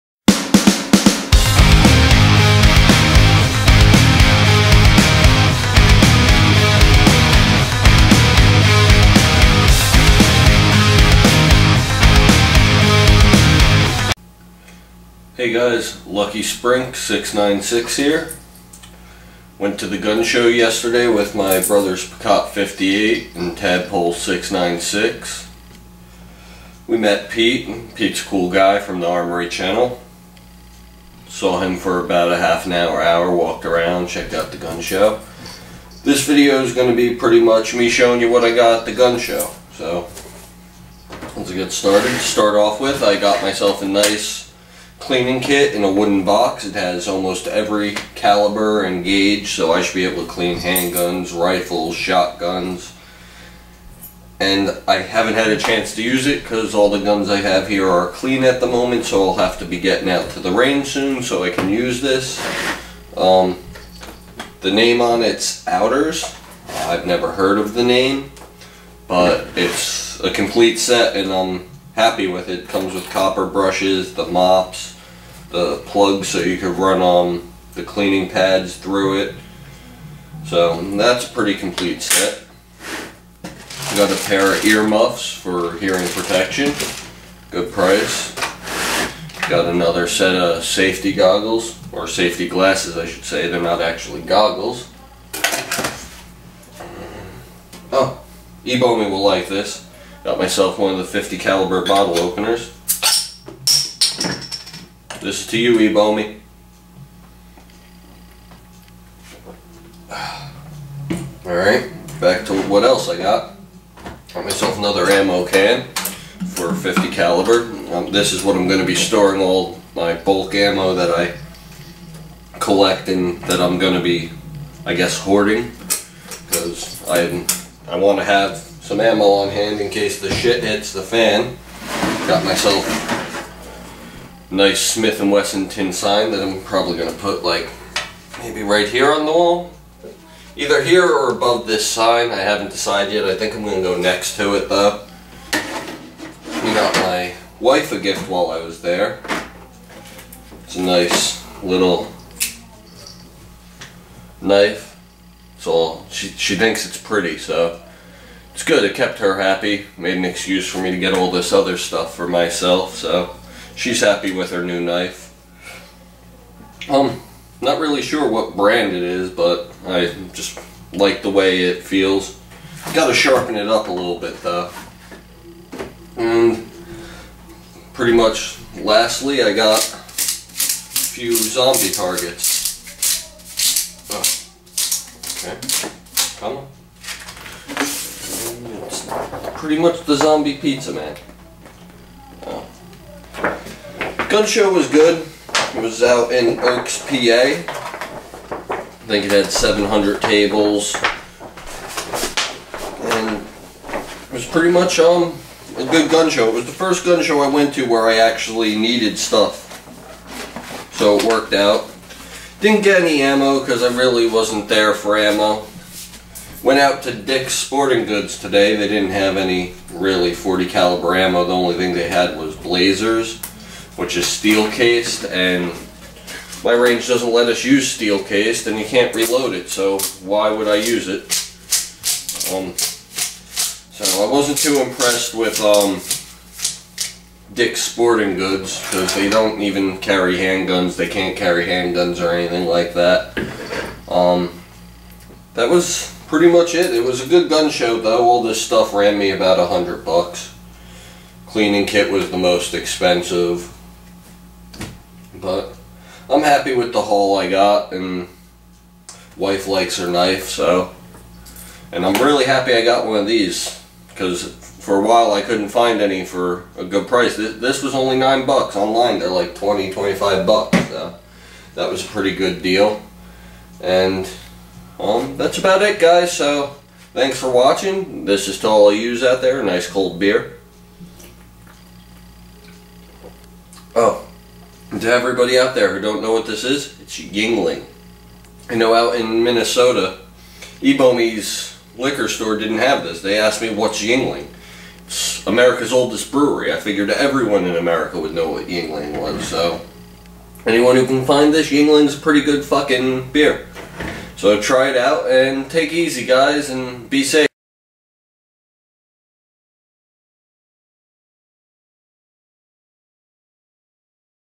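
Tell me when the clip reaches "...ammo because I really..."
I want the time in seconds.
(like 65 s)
213 s.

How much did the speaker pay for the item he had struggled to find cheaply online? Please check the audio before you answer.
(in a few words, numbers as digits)
9 bucks.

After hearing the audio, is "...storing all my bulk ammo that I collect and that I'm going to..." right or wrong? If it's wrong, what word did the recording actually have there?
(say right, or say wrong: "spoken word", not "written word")
right.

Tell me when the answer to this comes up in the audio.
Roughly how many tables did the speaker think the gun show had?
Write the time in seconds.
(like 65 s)
199 s.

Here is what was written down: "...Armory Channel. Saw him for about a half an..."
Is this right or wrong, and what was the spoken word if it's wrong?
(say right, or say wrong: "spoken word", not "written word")
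right.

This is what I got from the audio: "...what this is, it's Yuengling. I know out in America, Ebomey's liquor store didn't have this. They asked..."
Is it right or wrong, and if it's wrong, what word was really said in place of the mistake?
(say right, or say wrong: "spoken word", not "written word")
wrong: "Minnesota", not "America".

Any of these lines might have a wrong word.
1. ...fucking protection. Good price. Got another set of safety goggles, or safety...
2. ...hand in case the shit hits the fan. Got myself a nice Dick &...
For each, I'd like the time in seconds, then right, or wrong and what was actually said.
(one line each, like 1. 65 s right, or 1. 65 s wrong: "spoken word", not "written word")
1. 85 s wrong: "hearing", not "fucking"
2. 129 s wrong: "Smith", not "Dick".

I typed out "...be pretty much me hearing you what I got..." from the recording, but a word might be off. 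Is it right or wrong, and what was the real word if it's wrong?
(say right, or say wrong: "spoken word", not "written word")
wrong: "showing", not "hearing".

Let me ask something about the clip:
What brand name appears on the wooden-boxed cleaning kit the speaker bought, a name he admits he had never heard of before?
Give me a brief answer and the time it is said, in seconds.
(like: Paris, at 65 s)
Outers, at 65 s.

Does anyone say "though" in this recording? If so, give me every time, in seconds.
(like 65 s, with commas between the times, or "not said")
144 s, 174 s, 247 s.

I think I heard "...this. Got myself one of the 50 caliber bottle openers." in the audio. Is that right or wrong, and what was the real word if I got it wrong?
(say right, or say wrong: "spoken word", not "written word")
right.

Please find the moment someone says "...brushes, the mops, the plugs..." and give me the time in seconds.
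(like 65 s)
73 s.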